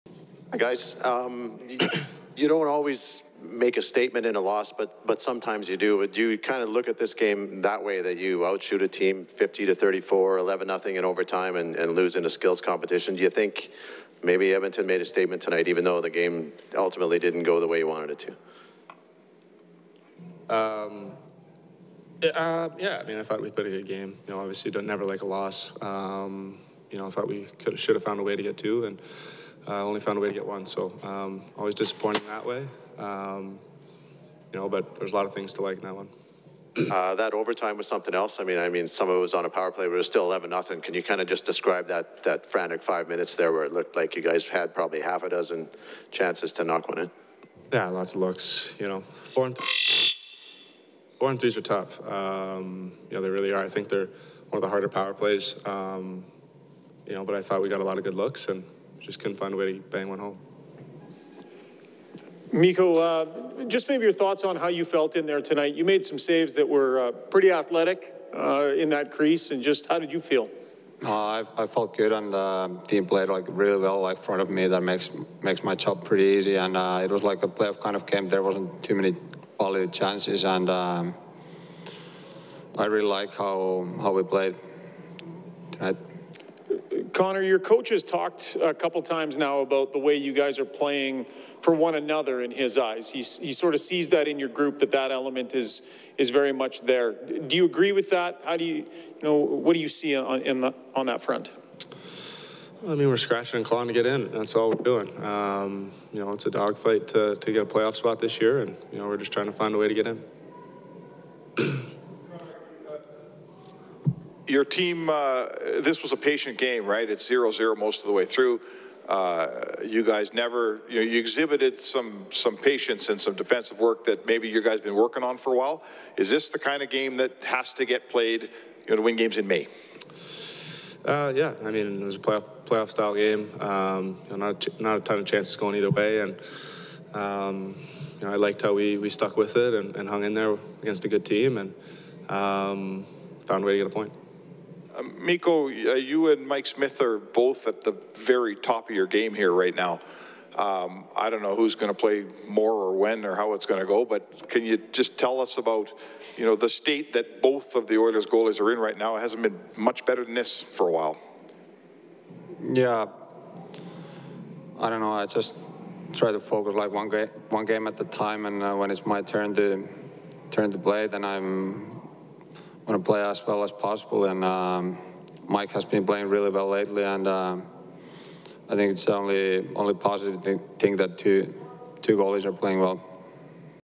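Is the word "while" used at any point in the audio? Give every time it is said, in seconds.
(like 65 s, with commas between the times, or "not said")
125 s, 160 s.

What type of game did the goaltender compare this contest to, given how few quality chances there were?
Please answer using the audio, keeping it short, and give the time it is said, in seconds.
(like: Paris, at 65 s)
playoff kind of game, at 77 s.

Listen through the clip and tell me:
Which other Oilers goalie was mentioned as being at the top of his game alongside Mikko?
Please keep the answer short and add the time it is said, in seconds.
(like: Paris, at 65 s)
Mike Smith, at 146 s.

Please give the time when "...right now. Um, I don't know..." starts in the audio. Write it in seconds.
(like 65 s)
149 s.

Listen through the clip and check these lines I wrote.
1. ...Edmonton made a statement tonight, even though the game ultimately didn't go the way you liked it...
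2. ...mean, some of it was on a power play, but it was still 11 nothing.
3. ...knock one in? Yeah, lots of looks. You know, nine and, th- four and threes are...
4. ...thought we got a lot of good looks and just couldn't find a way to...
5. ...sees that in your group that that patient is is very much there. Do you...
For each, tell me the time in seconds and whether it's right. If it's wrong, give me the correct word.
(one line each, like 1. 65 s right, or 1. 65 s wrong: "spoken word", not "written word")
1. 14 s wrong: "wanted", not "liked"
2. 38 s right
3. 46 s wrong: "four", not "nine"
4. 57 s right
5. 93 s wrong: "element", not "patient".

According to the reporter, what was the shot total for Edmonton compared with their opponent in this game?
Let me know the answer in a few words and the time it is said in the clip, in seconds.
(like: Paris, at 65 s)
50 to 34, at 9 s.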